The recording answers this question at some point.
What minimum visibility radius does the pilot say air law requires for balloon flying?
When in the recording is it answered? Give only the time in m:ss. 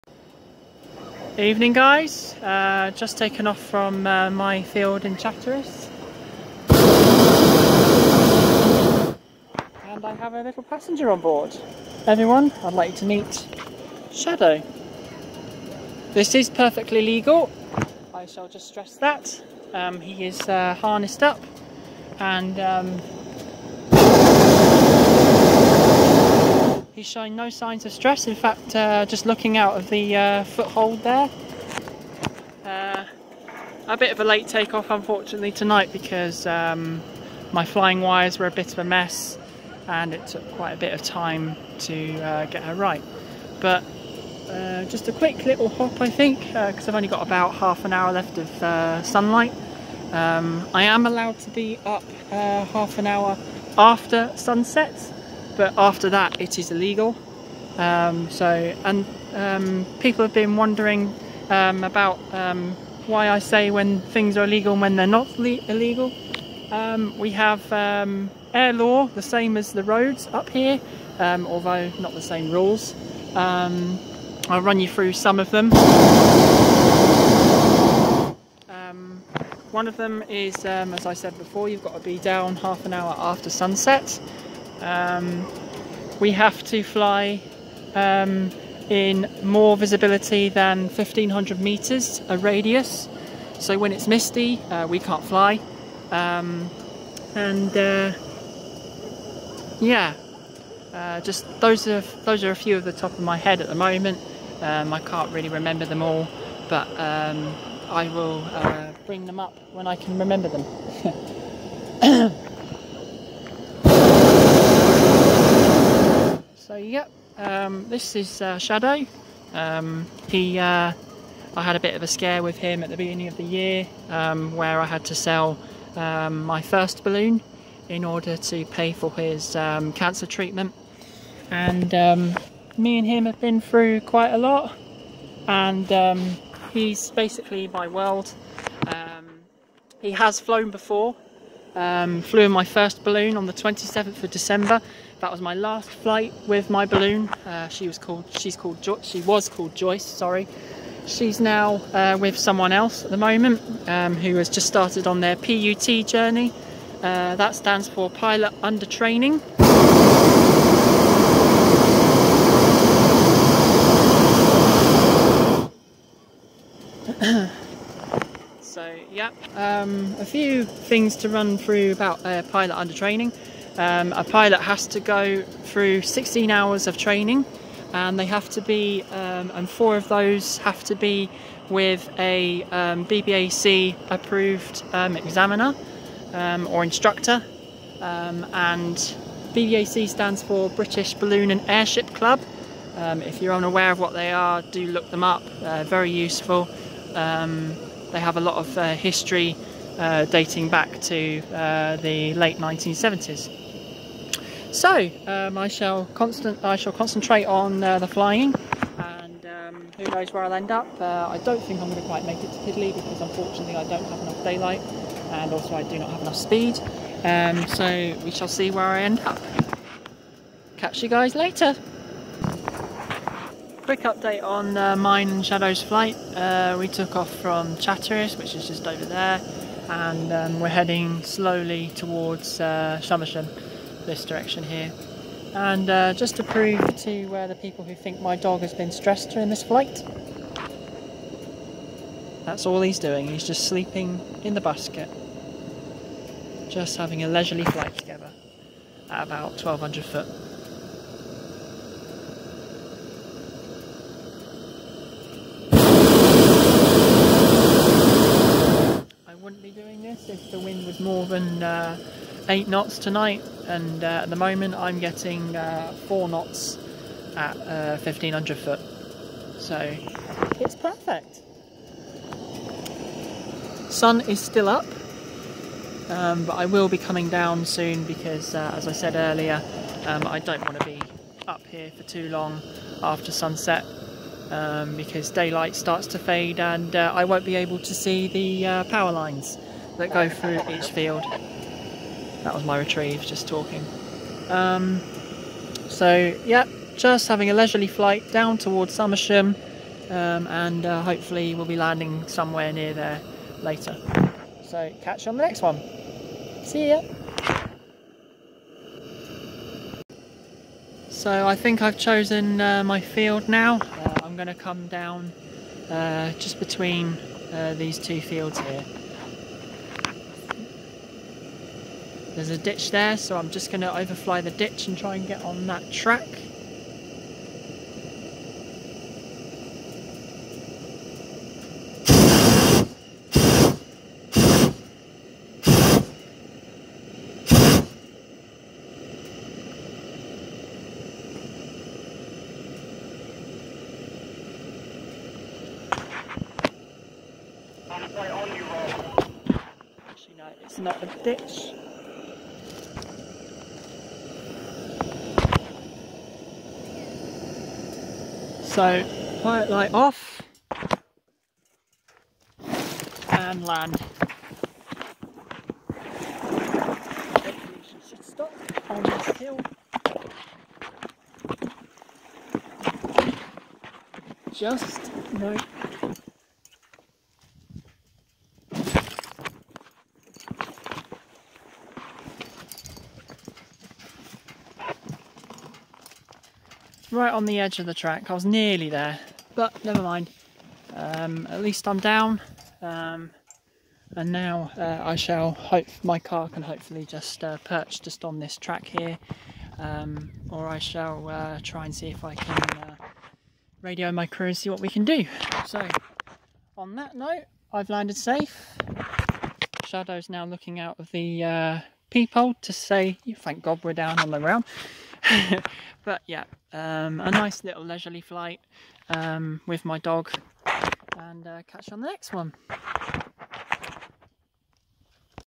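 1:30.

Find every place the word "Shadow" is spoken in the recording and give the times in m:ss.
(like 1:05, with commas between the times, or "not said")
0:14, 1:58, 3:45, 6:49.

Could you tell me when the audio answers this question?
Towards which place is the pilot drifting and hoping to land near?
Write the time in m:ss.
4:58.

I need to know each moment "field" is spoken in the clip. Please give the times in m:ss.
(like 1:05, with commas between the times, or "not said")
0:04, 4:50, 5:12, 5:18.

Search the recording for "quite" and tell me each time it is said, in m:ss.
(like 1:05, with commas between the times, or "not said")
0:40, 2:14, 3:32.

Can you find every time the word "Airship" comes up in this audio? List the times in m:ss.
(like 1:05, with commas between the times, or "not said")
3:11.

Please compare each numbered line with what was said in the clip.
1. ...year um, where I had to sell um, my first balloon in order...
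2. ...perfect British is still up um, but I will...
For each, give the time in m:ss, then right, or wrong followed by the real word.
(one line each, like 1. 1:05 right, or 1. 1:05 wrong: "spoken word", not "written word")
1. 2:03 right
2. 4:30 wrong: "Sun", not "British".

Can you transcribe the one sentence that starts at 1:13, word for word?
I'll run you through some of them.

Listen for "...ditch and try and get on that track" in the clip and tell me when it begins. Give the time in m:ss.
5:24.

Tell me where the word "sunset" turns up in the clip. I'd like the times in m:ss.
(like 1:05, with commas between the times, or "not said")
0:54, 1:23, 4:43.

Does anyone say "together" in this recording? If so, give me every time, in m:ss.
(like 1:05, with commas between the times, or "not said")
4:07.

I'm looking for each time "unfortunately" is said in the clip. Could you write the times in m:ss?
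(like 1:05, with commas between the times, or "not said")
0:34, 3:33.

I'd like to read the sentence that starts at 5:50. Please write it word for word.
Actually, no, it's not a ditch.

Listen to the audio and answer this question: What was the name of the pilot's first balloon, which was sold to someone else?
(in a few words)
Joyce.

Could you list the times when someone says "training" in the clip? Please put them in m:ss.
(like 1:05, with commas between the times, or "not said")
2:38, 2:52, 2:56.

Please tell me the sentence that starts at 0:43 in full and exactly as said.
But uh, just a quick little hop, I think, because uh, I've only got about half an hour left of sunlight.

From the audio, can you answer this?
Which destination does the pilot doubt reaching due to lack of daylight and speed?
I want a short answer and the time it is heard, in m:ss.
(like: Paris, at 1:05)
Pidley, at 3:32.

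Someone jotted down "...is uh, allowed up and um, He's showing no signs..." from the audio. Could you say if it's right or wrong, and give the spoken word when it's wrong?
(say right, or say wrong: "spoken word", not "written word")
wrong: "harnessed", not "allowed".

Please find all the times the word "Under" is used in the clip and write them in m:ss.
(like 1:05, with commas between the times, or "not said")
2:38, 2:52.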